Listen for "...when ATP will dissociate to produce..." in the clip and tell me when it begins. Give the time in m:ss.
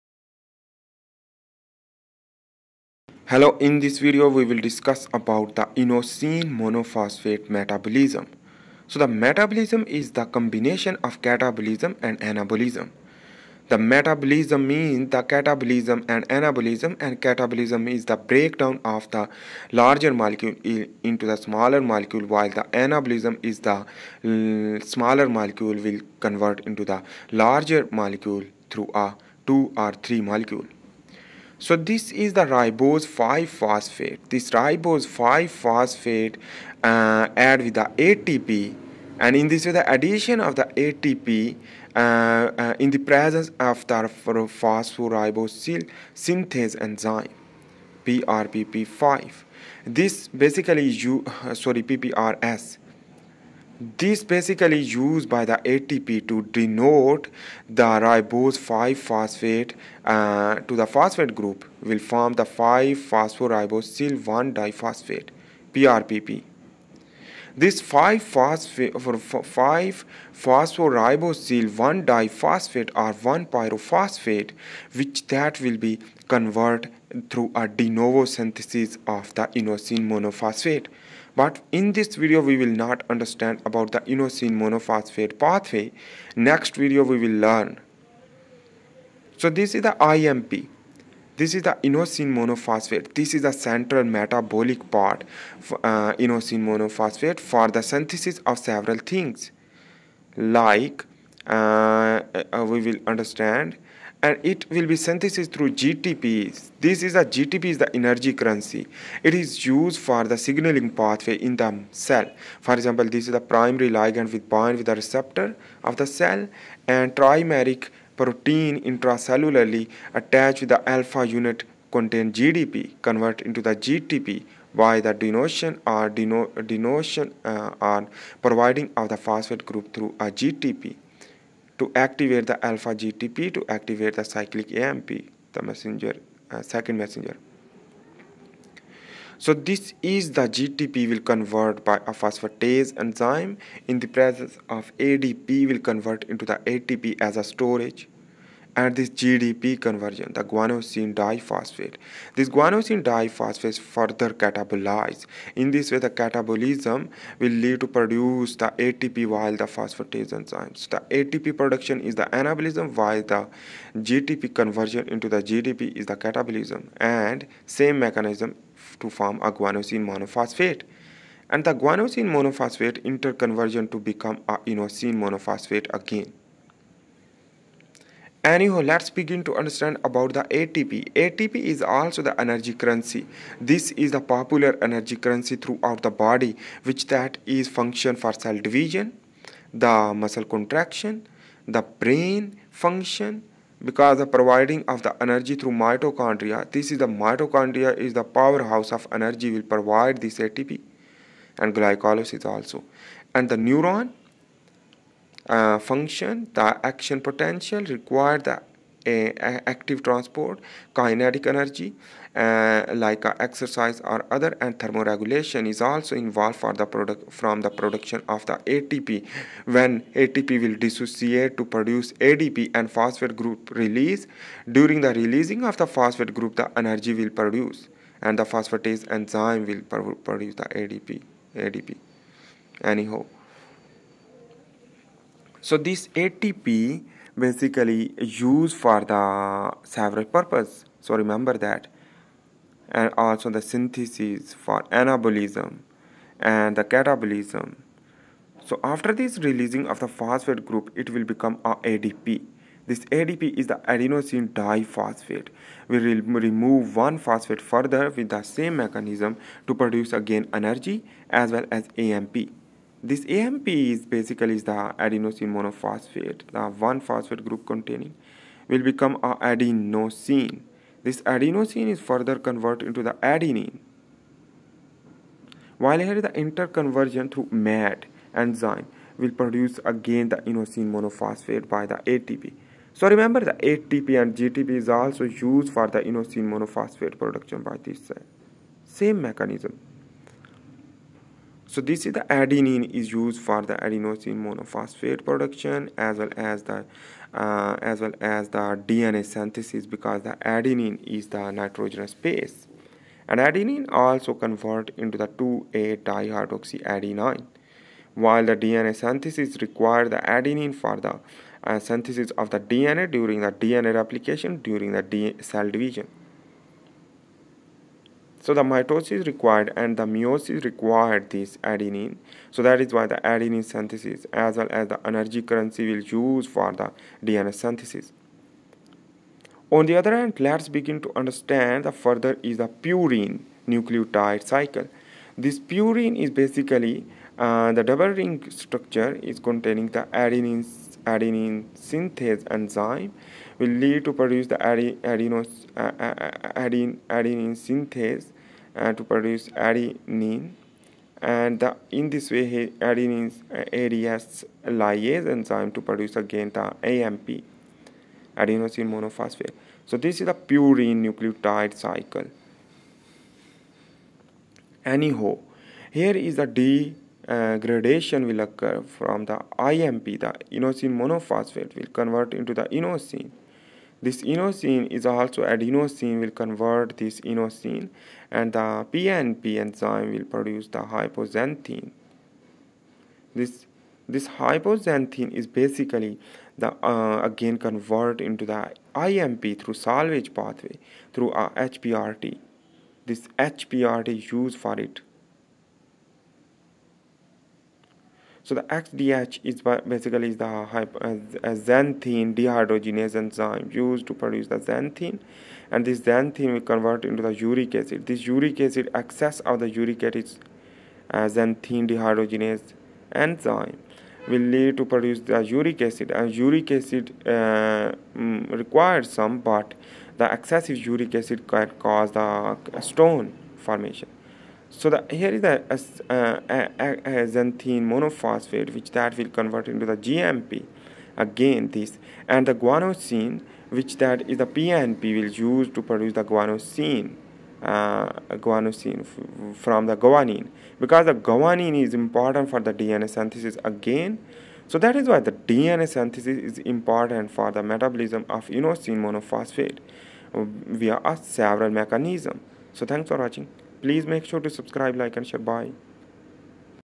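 3:39.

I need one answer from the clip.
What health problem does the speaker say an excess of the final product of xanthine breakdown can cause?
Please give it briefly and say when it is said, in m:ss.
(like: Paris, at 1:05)
Stone formation, at 7:02.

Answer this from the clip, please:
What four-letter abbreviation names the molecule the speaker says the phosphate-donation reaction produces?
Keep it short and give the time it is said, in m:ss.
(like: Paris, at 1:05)
PRPP, at 1:05.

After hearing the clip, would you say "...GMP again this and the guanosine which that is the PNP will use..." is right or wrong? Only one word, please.
right.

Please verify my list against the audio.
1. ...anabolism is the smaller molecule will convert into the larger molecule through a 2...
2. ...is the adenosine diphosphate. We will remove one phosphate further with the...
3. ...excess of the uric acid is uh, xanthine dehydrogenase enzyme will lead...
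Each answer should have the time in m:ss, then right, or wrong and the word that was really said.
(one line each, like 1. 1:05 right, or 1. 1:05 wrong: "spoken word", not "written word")
1. 0:22 right
2. 4:13 right
3. 6:48 right.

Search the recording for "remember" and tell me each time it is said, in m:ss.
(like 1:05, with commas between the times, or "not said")
4:01, 4:43.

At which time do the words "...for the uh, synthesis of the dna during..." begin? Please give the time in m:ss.
5:10.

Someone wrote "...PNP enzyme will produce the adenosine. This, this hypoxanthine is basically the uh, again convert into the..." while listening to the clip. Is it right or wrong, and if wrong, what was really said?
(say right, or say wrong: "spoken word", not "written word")
wrong: "hypoxanthine", not "adenosine".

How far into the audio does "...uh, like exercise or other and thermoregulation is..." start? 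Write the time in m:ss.
3:32.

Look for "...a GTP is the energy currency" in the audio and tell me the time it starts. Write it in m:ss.
1:47.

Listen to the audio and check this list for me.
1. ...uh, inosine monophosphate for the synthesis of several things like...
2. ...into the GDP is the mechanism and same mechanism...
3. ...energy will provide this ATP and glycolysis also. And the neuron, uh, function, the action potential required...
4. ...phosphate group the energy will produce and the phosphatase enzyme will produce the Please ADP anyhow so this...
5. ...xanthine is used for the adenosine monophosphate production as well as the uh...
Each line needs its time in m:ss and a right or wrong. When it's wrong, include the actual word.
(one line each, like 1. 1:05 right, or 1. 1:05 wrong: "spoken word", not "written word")
1. 1:35 right
2. 2:45 wrong: "catabolism", not "mechanism"
3. 3:19 right
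4. 3:45 wrong: "ADP", not "Please"
5. 4:52 wrong: "adenine", not "xanthine".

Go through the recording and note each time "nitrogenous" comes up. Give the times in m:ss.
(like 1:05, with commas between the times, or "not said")
5:01.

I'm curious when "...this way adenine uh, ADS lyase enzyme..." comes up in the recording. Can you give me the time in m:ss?
5:52.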